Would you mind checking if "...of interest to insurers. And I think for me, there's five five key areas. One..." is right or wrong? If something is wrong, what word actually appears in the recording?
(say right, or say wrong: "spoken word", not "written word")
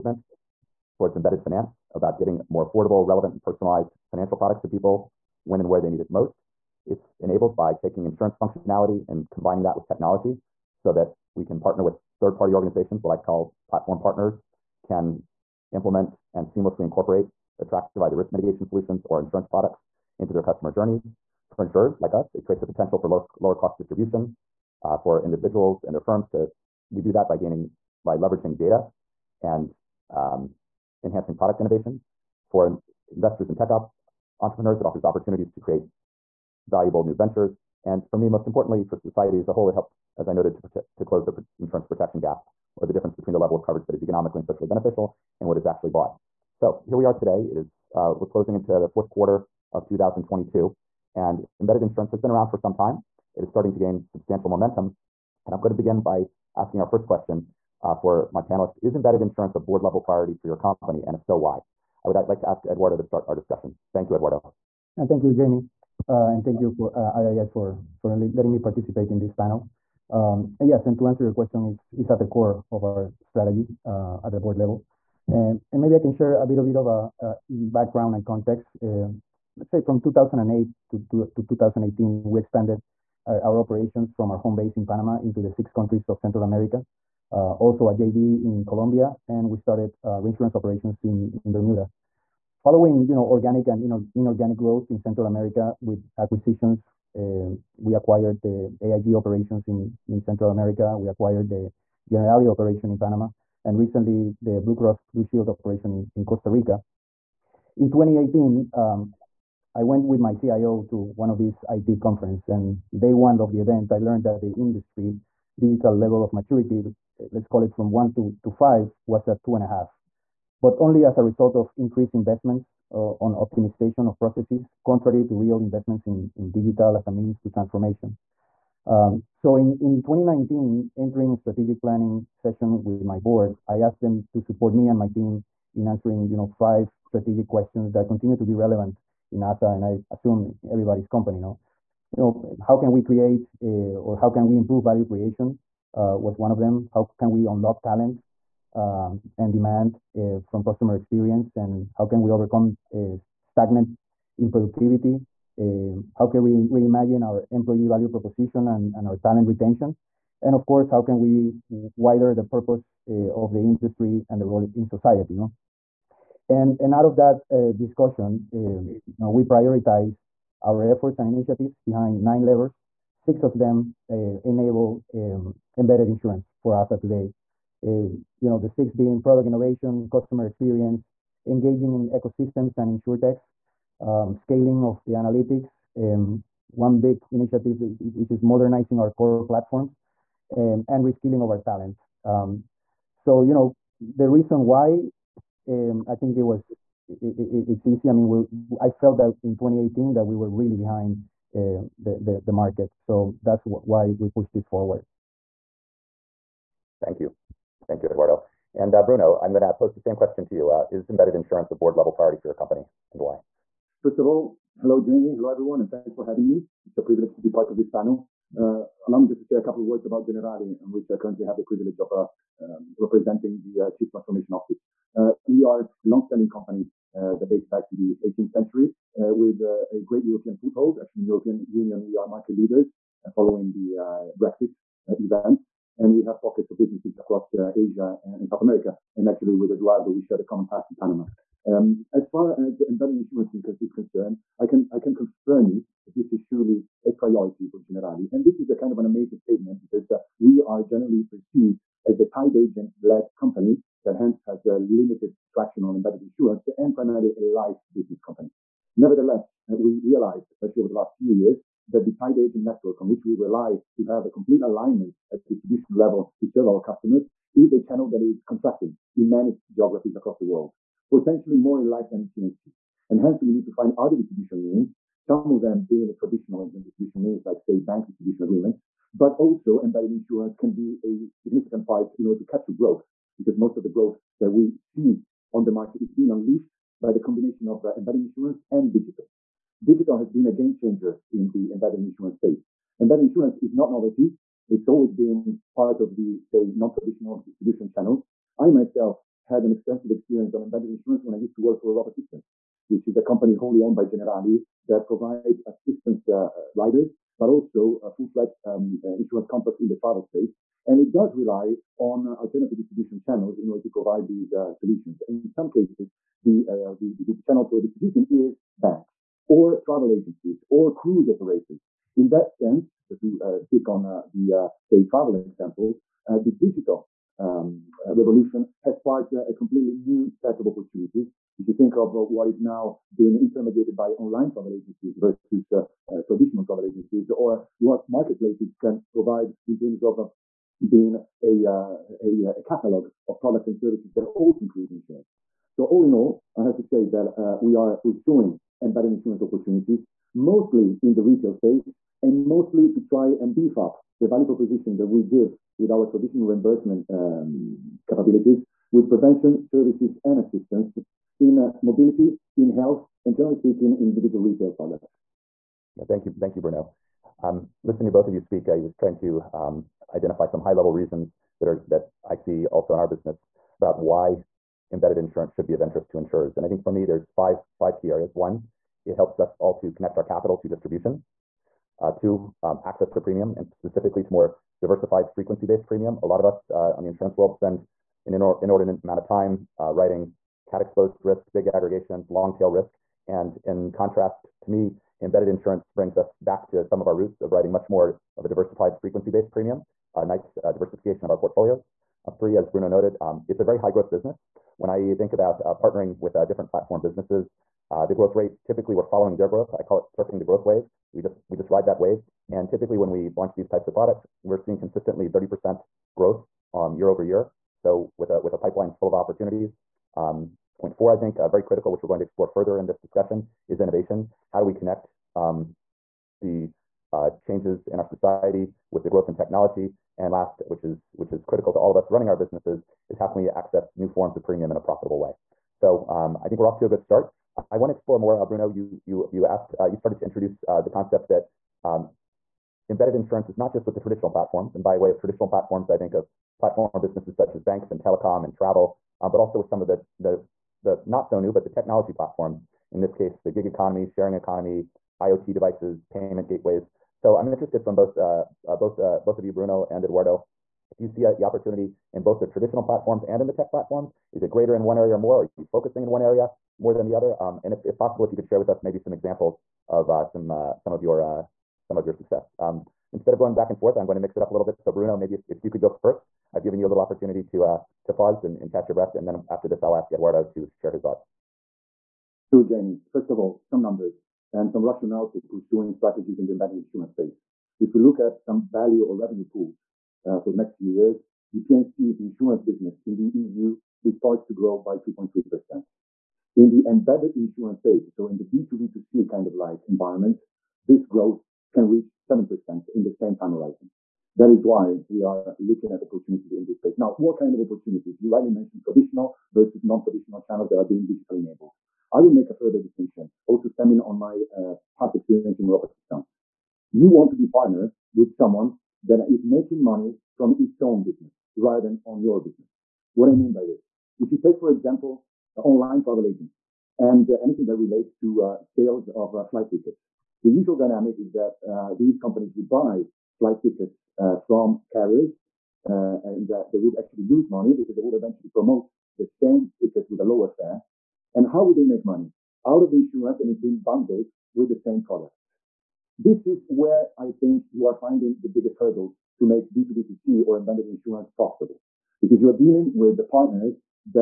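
right.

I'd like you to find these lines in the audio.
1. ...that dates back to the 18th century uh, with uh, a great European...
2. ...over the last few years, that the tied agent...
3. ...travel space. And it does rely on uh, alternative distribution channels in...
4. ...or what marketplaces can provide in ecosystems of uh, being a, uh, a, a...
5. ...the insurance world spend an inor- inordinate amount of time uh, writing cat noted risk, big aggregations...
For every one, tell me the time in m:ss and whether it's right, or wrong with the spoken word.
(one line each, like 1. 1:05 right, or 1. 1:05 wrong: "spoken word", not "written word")
1. 3:47 right
2. 4:20 right
3. 5:10 right
4. 5:37 wrong: "terms", not "ecosystems"
5. 6:27 wrong: "exposed", not "noted".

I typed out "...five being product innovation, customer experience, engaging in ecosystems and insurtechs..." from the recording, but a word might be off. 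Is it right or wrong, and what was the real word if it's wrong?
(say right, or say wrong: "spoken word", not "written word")
wrong: "six", not "five".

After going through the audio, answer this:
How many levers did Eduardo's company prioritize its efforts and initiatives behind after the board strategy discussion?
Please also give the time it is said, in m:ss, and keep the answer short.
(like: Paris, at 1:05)
9, at 2:52.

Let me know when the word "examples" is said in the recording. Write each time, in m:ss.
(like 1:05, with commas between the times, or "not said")
5:25, 7:49, 8:44.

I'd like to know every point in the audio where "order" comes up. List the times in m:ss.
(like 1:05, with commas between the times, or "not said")
4:42, 5:13.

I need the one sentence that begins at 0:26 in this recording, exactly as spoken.
We do that by gaining, by leveraging data and um, enhancing product innovation.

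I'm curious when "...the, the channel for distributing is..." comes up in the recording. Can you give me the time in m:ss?
5:17.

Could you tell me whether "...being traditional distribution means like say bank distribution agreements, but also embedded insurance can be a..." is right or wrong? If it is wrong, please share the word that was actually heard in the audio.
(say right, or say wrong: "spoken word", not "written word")
right.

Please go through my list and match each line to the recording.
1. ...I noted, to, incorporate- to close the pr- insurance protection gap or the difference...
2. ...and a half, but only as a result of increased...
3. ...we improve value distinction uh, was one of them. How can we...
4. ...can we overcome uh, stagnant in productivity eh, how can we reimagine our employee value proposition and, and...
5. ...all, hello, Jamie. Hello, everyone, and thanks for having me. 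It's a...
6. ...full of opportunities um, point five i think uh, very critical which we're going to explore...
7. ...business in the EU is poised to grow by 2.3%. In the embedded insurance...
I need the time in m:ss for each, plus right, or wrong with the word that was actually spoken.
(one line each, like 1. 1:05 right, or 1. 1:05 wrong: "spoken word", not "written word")
1. 0:40 wrong: "prote", not "incorporate"
2. 1:59 right
3. 2:24 wrong: "creation", not "distinction"
4. 2:32 right
5. 3:34 right
6. 6:58 wrong: "four", not "five"
7. 8:12 right.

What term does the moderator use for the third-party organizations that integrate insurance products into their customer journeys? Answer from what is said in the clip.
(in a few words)
platform partners.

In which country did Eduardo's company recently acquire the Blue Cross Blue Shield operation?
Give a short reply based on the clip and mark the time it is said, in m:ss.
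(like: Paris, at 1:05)
Costa Rica, at 1:46.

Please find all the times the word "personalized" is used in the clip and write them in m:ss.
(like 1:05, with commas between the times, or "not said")
0:03.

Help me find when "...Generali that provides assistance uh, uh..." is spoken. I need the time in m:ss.
5:04.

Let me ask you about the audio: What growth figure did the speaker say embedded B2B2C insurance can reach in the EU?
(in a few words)
7%.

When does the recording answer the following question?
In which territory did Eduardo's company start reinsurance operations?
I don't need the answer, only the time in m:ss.
1:31.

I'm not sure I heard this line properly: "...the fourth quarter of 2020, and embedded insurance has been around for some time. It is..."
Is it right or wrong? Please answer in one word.
wrong.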